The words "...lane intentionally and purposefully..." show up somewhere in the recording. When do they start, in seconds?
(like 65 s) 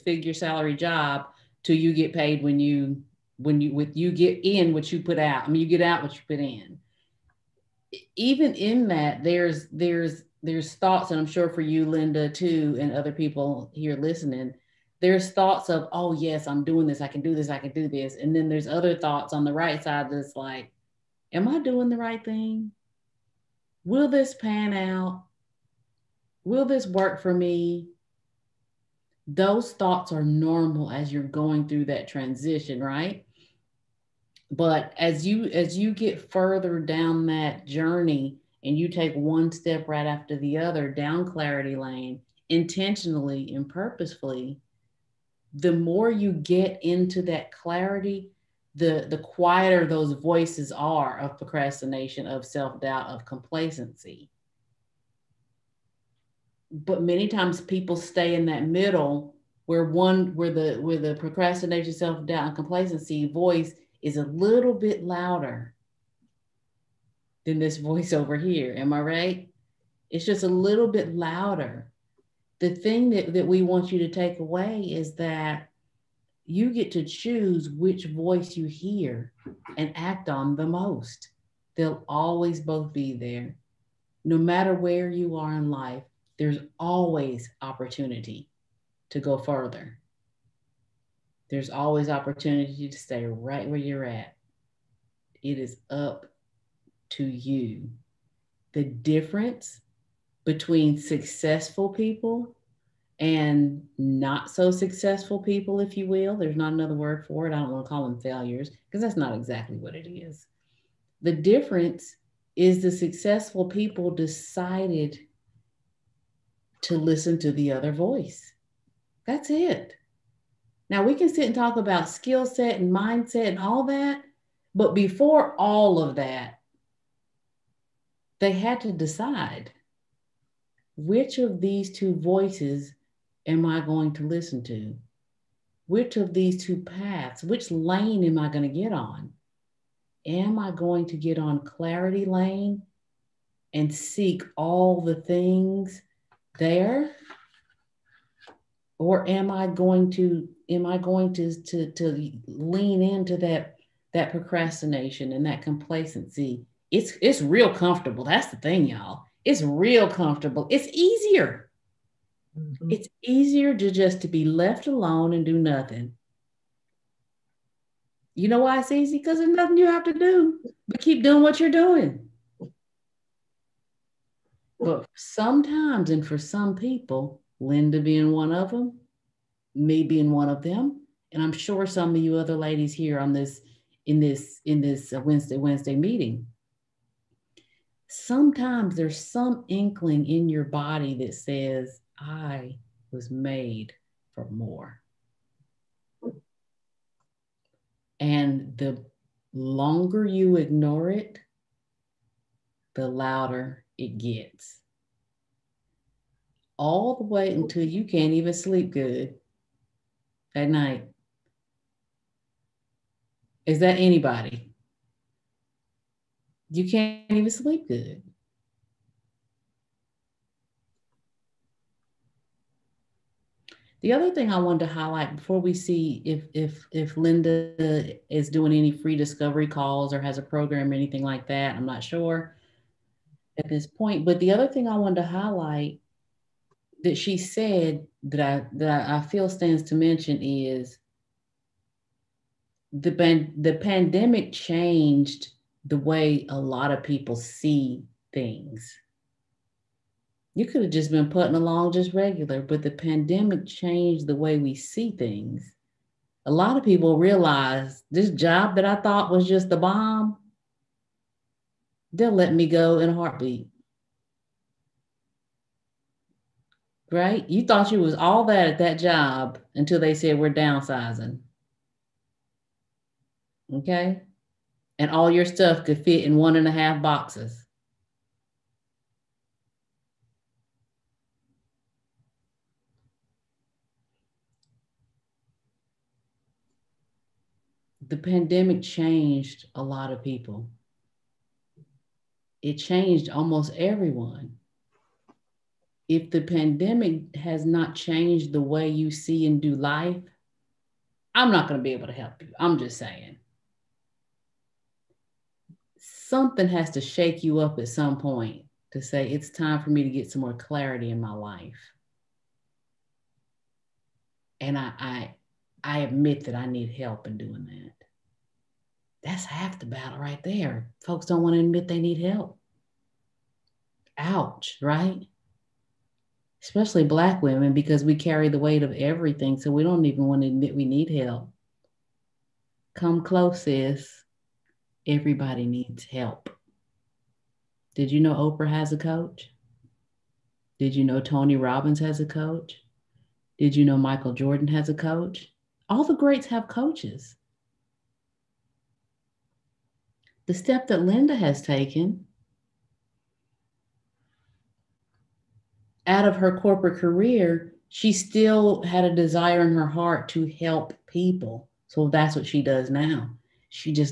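41 s.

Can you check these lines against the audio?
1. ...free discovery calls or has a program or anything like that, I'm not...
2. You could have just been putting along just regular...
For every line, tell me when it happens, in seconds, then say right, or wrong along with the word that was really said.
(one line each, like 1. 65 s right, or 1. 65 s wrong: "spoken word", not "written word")
1. 228 s right
2. 250 s right.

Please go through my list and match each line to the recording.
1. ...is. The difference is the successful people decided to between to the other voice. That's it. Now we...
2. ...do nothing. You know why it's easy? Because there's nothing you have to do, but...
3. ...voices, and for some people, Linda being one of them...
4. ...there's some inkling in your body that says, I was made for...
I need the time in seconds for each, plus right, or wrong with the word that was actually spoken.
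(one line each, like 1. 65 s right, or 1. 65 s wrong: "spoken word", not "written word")
1. 110 s wrong: "listen", not "between"
2. 165 s right
3. 175 s wrong: "sometimes", not "voices"
4. 188 s right.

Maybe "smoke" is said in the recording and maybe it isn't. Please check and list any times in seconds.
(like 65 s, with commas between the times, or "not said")
not said.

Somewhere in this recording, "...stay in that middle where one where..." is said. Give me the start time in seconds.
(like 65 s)
57 s.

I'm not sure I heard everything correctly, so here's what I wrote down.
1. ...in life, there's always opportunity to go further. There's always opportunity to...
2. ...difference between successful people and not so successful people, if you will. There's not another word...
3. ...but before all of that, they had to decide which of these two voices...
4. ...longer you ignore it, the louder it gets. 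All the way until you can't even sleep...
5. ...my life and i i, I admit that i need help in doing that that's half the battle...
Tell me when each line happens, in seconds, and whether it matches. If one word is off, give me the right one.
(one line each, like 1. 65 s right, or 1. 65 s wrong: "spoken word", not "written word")
1. 85 s right
2. 98 s right
3. 124 s right
4. 199 s right
5. 311 s right.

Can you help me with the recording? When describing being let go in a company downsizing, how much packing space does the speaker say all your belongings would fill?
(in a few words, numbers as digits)
one and a half boxes.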